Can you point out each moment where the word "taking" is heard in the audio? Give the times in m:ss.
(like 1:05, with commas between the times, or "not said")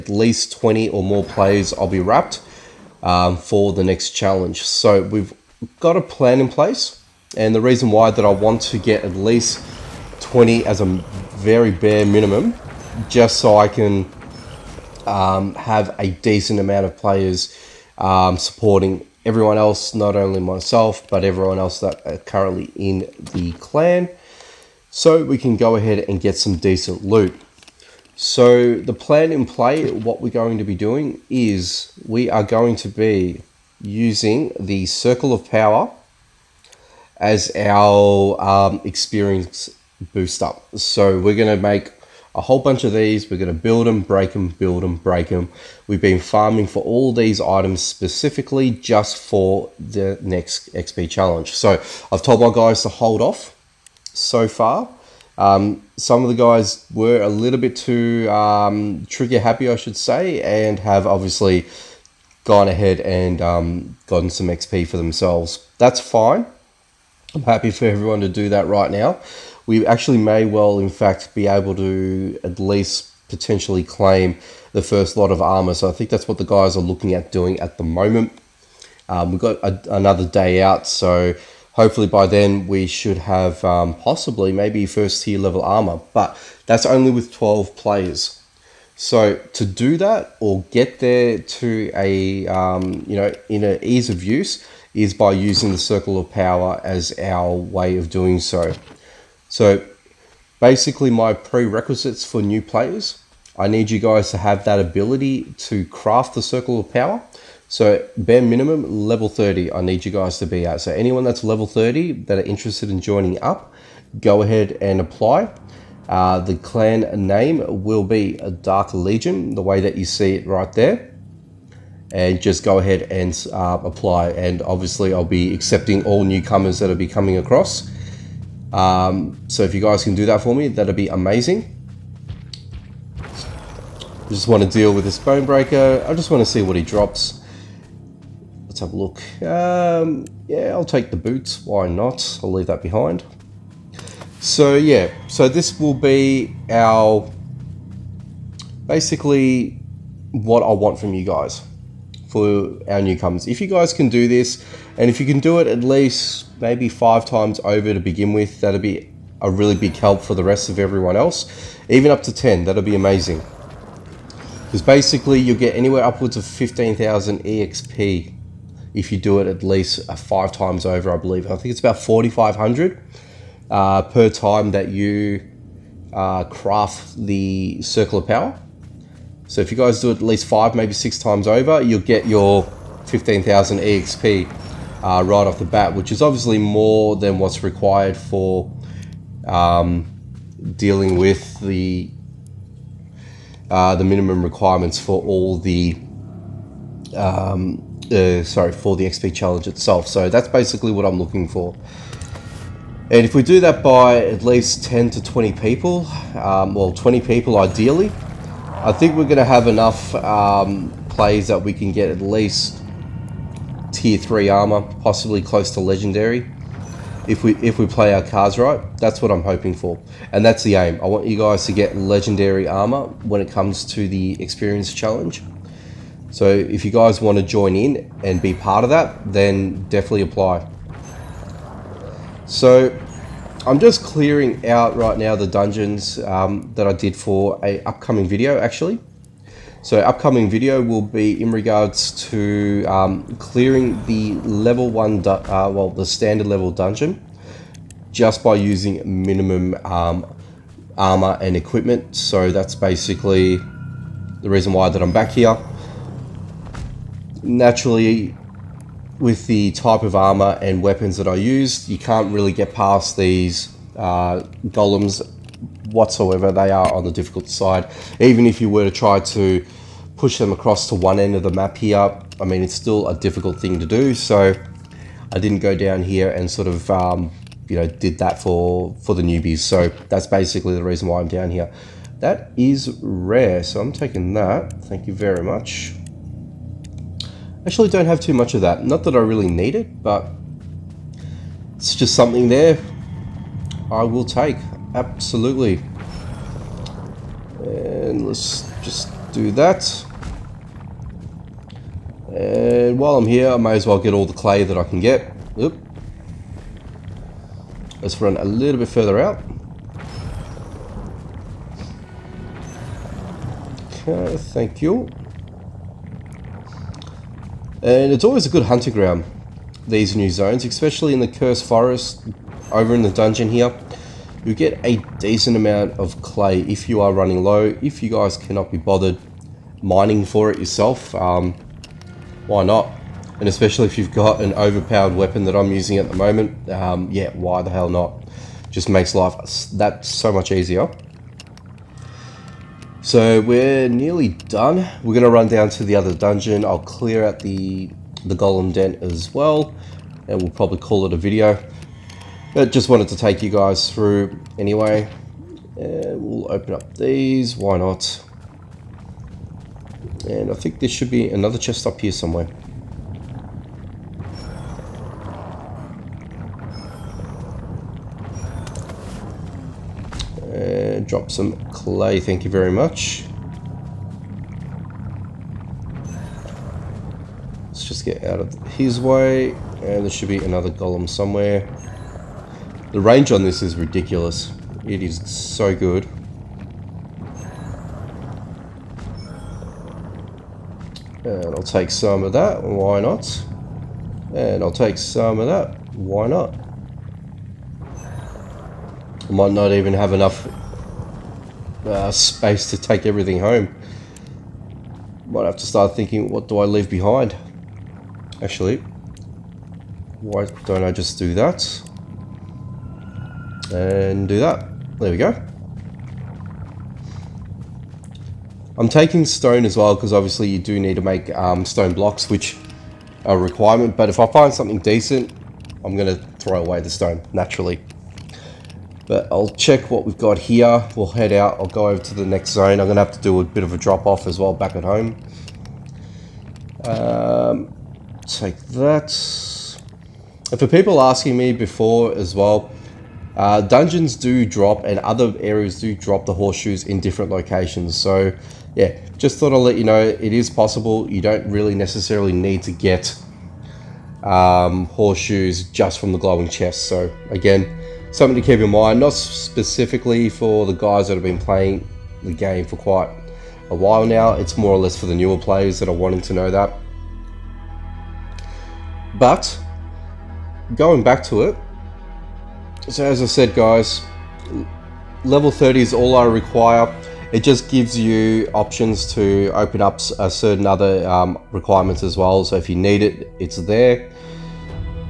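4:43, 6:58.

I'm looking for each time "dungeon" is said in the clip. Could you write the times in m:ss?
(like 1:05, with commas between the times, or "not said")
3:55, 4:06, 5:23, 5:46, 7:23.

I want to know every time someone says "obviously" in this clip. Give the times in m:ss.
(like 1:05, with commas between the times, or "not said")
1:01, 2:04, 3:06, 7:00.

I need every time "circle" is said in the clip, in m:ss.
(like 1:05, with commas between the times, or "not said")
0:34, 1:35, 1:46, 2:57.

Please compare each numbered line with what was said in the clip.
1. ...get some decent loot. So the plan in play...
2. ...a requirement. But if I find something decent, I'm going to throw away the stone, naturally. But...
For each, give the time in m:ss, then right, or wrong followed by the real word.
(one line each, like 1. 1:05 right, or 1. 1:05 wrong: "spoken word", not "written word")
1. 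0:26 right
2. 7:03 right.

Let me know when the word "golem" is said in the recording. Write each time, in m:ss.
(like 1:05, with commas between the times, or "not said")
4:24, 5:48, 6:20.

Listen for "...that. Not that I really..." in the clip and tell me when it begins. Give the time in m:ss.
4:48.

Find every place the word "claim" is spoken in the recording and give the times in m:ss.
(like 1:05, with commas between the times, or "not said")
1:13.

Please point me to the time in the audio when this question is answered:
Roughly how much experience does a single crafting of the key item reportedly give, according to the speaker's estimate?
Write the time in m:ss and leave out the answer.
2:51.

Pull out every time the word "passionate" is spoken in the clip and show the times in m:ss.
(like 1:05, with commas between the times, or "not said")
not said.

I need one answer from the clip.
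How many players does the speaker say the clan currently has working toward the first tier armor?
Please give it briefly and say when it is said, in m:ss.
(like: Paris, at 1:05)
12, at 1:27.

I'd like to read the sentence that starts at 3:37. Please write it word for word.
If we if we play our cards right, that's what I'm hoping for.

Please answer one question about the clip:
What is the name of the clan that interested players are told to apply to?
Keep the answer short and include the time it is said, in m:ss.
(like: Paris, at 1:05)
Dark Legion, at 1:58.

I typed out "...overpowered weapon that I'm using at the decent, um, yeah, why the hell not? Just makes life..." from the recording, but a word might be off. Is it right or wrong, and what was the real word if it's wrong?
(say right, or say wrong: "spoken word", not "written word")
wrong: "moment", not "decent".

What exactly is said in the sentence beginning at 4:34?
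So I didn't go down here and sort of, um, you know, did that for, for the newbies.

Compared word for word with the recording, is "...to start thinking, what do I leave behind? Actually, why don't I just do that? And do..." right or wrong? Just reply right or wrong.
right.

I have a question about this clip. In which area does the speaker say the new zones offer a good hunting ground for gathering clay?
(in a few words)
Cursed Forest.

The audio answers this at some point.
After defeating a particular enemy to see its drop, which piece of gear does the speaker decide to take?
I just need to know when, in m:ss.
2:21.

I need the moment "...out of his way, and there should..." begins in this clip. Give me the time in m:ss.
6:18.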